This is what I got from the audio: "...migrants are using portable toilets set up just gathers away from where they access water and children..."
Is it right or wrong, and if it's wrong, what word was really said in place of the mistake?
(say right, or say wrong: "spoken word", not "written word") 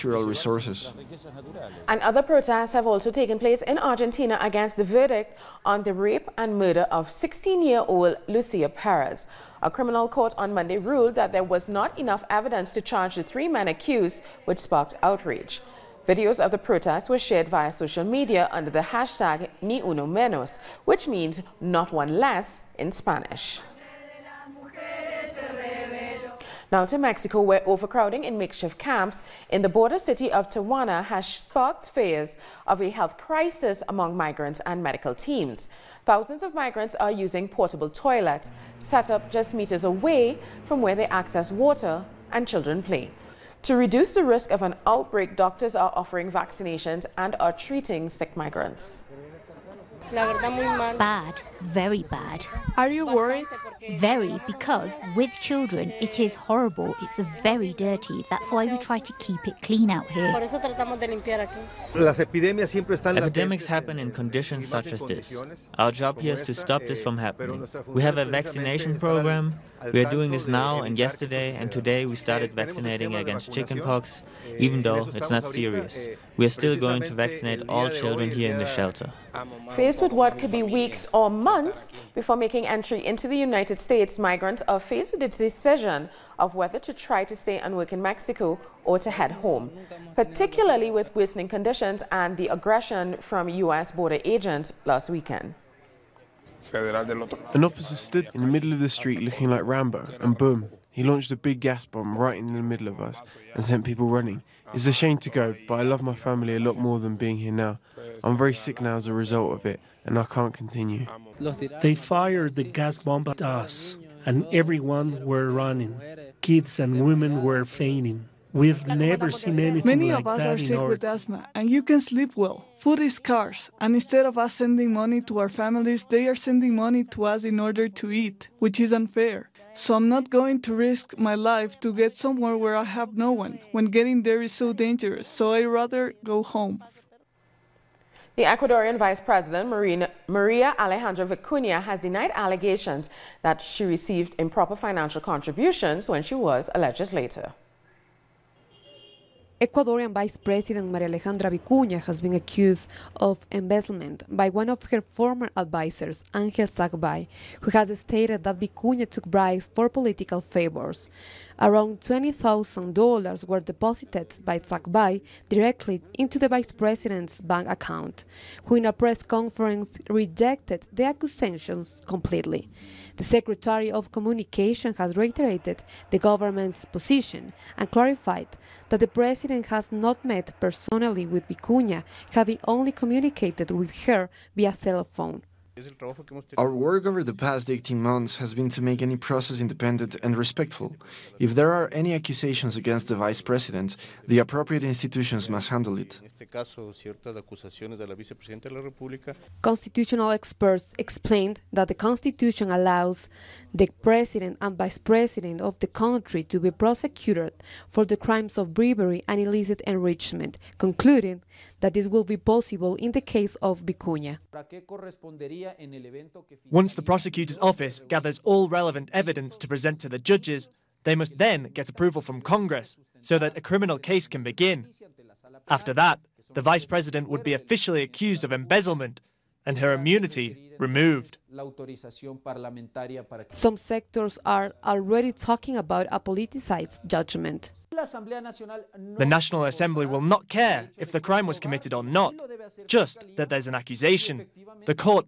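wrong: "meters", not "gathers".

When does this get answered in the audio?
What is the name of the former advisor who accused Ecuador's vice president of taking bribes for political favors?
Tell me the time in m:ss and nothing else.
2:36.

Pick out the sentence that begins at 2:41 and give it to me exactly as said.
Around $20,000 were deposited by Sagbay directly into the vice president's bank account, who in a press conference rejected the accusations completely.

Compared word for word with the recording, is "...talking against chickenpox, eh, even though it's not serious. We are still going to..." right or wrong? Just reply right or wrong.
wrong.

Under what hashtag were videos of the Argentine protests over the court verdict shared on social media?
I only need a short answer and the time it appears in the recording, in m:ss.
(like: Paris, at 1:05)
Ni Uno Menos, at 0:19.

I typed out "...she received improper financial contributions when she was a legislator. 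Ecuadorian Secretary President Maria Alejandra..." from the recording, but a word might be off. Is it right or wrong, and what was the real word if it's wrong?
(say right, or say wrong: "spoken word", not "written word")
wrong: "Vice", not "Secretary".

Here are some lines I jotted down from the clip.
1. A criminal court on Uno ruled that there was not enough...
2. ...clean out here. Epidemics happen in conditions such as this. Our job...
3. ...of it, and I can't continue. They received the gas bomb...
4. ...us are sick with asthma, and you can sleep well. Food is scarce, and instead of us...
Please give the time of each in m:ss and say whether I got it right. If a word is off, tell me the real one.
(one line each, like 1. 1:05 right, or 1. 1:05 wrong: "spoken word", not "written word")
1. 0:09 wrong: "Monday", not "Uno"
2. 0:59 right
3. 1:49 wrong: "fired", not "received"
4. 2:00 right.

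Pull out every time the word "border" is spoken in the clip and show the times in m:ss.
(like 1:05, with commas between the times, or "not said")
0:29, 1:33.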